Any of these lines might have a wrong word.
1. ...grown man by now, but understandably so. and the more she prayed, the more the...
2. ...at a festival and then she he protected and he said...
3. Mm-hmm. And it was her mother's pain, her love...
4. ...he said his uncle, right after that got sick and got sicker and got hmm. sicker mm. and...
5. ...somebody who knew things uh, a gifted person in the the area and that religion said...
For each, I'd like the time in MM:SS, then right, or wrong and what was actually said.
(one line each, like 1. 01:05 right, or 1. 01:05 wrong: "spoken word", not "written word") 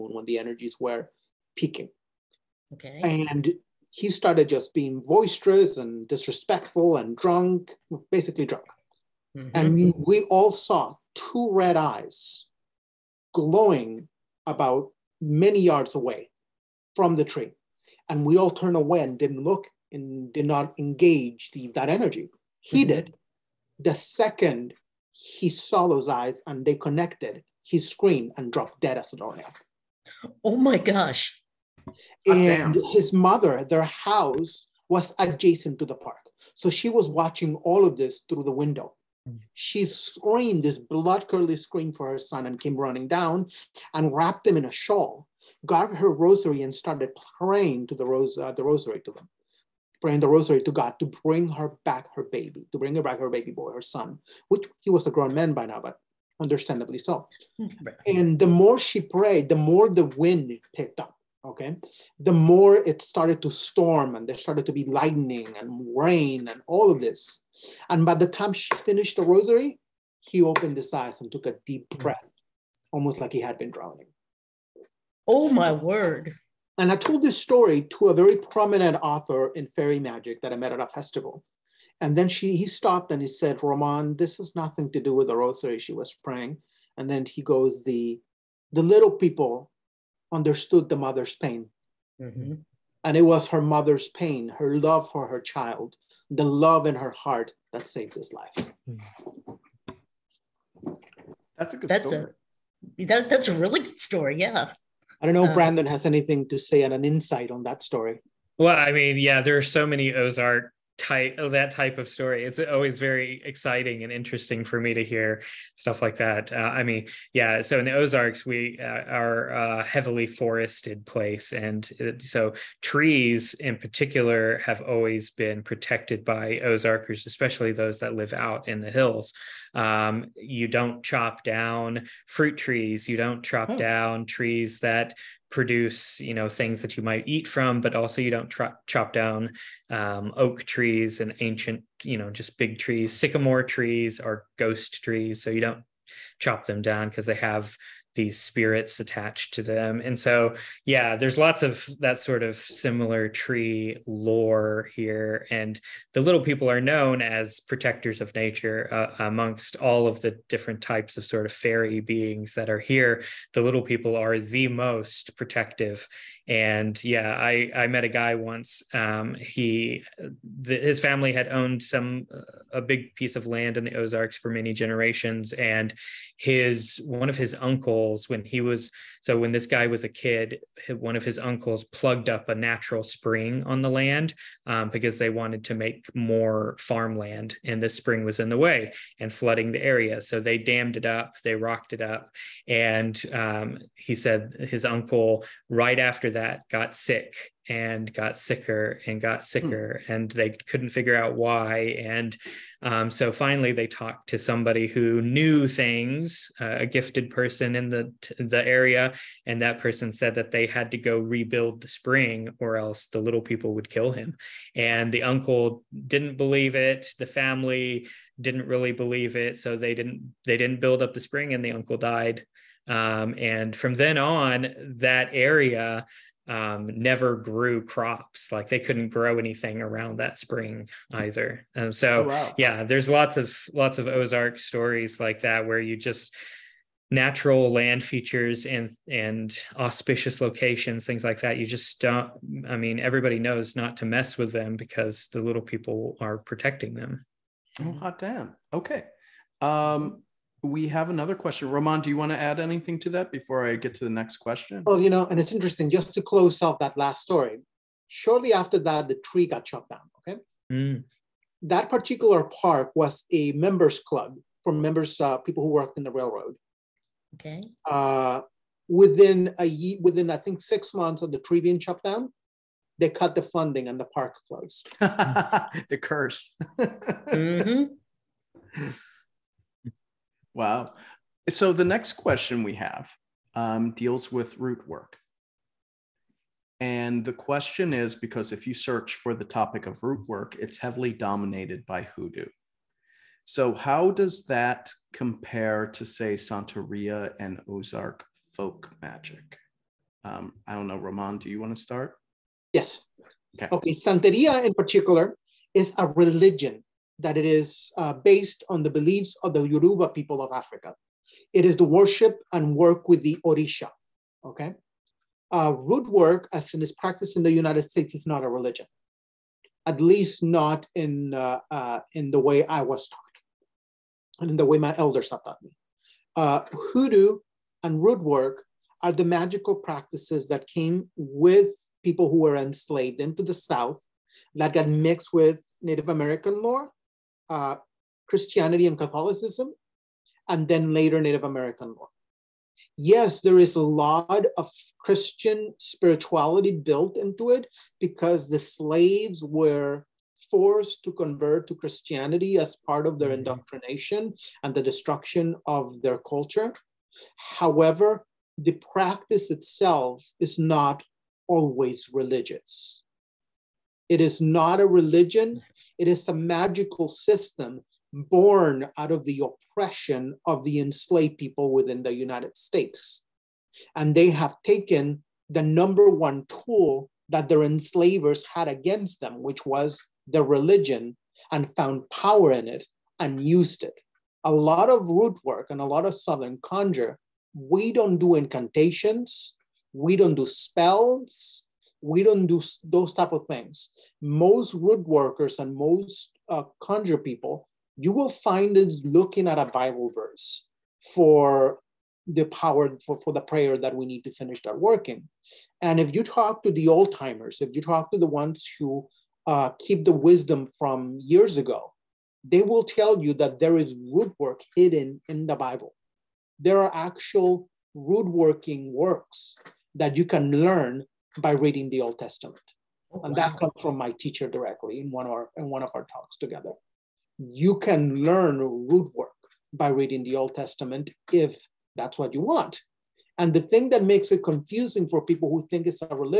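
1. 00:55 right
2. 01:20 wrong: "stopped", not "protected"
3. 01:32 right
4. 03:13 right
5. 03:24 wrong: "person", not "religion".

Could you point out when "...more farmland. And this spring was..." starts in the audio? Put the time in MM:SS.
03:06.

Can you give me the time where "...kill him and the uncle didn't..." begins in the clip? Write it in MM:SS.
03:33.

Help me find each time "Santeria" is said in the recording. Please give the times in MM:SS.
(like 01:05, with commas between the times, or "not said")
04:56, 05:03.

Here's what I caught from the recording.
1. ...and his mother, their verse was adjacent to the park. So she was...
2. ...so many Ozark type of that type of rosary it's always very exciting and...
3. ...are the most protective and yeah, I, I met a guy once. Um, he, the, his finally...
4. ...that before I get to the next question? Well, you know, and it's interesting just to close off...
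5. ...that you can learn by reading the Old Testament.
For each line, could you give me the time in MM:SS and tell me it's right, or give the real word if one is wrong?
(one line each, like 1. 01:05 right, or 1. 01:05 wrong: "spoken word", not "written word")
1. 00:32 wrong: "house", not "verse"
2. 01:49 wrong: "story", not "rosary"
3. 02:44 wrong: "family", not "finally"
4. 04:13 right
5. 06:59 right.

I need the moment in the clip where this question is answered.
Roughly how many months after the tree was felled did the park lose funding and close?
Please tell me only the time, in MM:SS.
04:30.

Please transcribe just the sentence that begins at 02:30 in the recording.
And so, yeah, there's lots of that sort of similar tree lore here.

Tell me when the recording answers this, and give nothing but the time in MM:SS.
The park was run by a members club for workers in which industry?
04:26.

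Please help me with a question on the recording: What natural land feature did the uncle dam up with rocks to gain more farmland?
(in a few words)
a natural spring.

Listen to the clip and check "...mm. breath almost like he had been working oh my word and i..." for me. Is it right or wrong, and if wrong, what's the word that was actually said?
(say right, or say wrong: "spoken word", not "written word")
wrong: "drowning", not "working".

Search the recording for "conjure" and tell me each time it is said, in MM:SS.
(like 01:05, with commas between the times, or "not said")
06:26, 06:36.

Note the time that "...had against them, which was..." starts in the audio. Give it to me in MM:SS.
06:18.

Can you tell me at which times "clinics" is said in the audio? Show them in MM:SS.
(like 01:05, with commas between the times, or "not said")
not said.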